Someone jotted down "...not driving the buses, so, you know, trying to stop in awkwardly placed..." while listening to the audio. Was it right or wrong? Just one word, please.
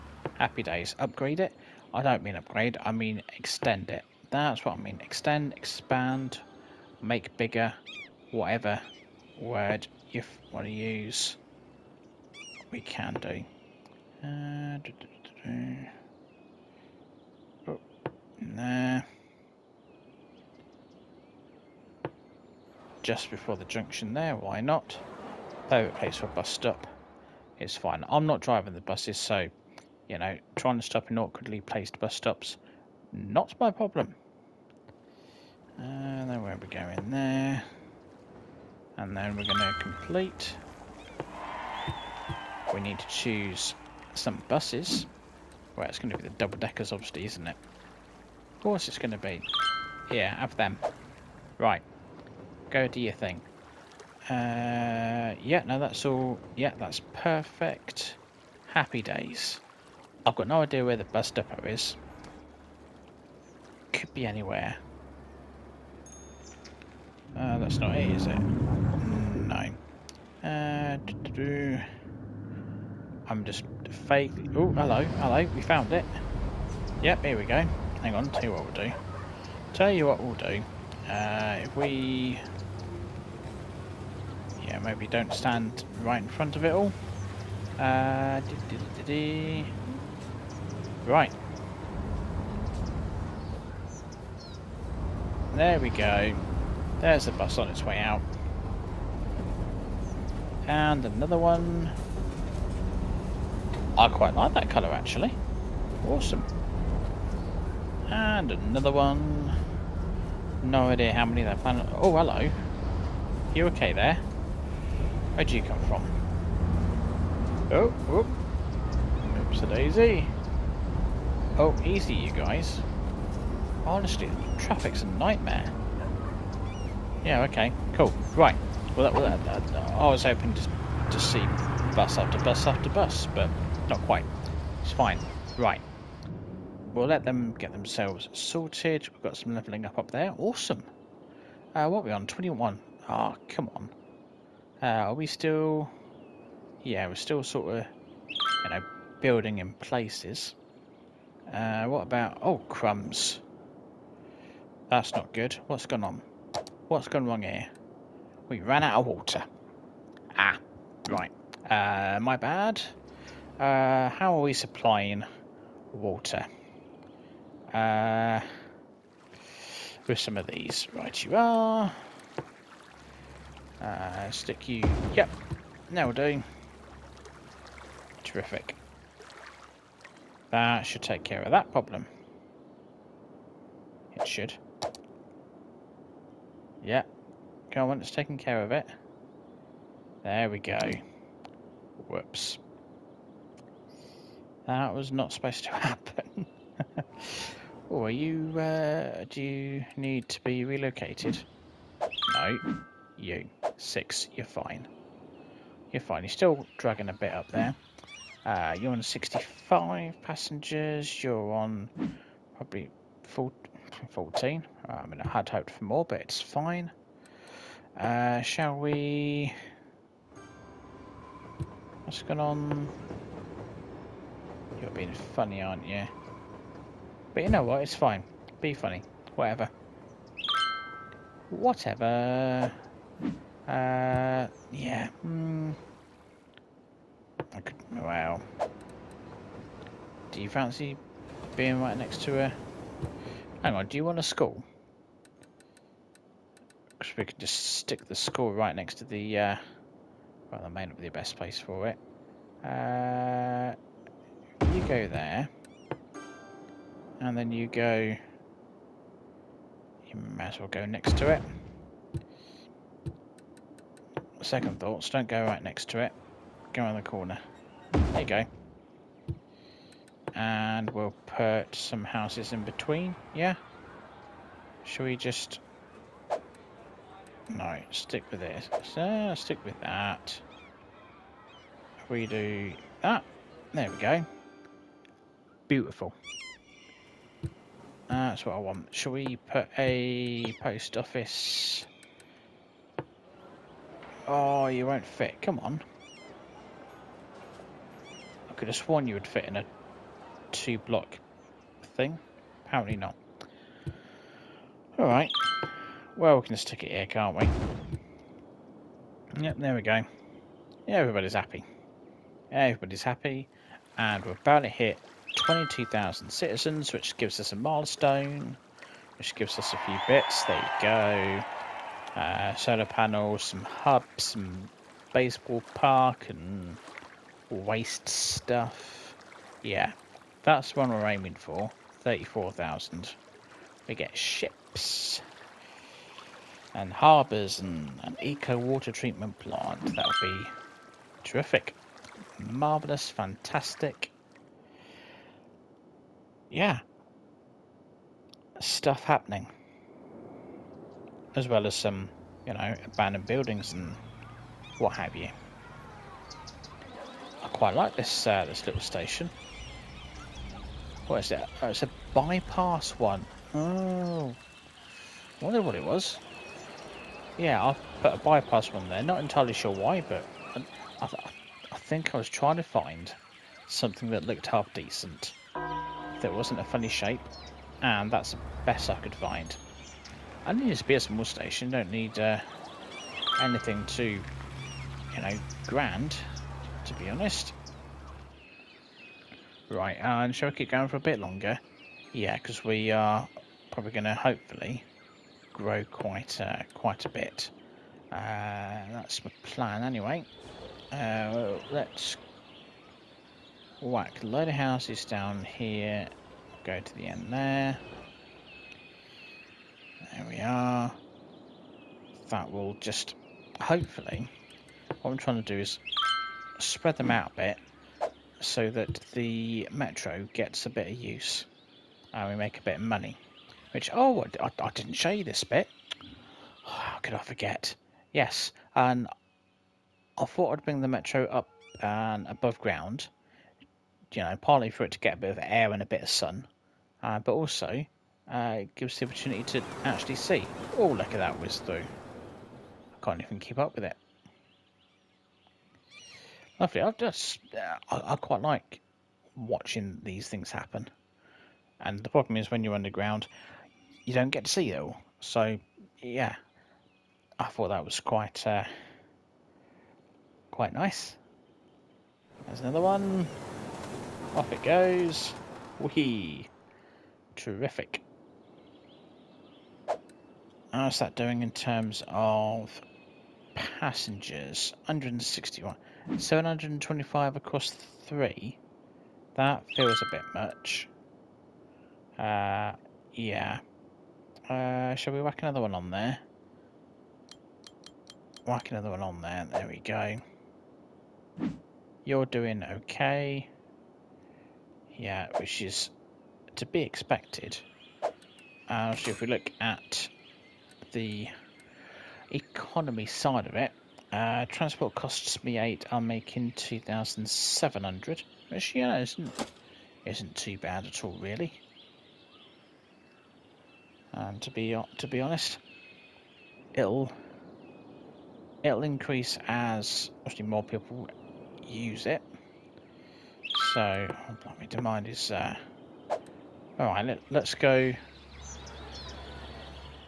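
right.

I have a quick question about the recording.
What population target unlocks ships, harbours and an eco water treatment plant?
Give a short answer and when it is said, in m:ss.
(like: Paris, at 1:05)
34,000, at 5:32.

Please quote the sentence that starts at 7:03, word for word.
Which, oh, I, I didn't show you this bit.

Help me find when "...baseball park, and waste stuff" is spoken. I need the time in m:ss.
5:25.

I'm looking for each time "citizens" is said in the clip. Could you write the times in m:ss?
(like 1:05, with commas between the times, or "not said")
5:16.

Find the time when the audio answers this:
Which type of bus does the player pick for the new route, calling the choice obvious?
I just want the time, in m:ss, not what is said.
0:46.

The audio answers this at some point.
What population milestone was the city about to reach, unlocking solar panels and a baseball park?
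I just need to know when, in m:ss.
5:15.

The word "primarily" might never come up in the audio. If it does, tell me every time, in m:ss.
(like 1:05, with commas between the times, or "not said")
not said.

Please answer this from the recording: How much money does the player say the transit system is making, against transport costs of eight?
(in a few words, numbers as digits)
2,700.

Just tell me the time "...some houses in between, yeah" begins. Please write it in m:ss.
4:31.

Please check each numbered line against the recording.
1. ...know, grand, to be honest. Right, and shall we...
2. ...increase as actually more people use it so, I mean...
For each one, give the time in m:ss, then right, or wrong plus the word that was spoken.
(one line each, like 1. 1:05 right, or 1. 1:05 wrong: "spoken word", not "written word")
1. 6:25 right
2. 8:38 right.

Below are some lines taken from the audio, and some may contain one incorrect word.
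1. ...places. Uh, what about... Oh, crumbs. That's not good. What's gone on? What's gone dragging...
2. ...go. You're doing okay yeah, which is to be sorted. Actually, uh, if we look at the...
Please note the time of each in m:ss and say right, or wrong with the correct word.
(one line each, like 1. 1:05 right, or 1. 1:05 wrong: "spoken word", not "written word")
1. 2:29 wrong: "wrong", not "dragging"
2. 8:09 wrong: "expected", not "sorted".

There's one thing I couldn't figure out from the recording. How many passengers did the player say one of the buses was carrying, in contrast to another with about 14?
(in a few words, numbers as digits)
65.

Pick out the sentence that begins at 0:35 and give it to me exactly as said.
And uh, then we are going there.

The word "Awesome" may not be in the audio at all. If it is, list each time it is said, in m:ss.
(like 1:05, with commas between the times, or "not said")
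1:46, 2:20.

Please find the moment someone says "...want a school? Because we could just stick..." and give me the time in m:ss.
4:04.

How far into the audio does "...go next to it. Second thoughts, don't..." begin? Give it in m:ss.
4:20.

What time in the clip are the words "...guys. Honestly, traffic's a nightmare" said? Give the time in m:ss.
2:02.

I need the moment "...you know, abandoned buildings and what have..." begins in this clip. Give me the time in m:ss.
5:52.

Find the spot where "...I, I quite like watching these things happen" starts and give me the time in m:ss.
7:27.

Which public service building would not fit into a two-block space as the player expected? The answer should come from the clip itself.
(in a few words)
Post office.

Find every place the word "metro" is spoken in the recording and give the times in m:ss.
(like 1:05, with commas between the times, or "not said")
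6:59, 7:10.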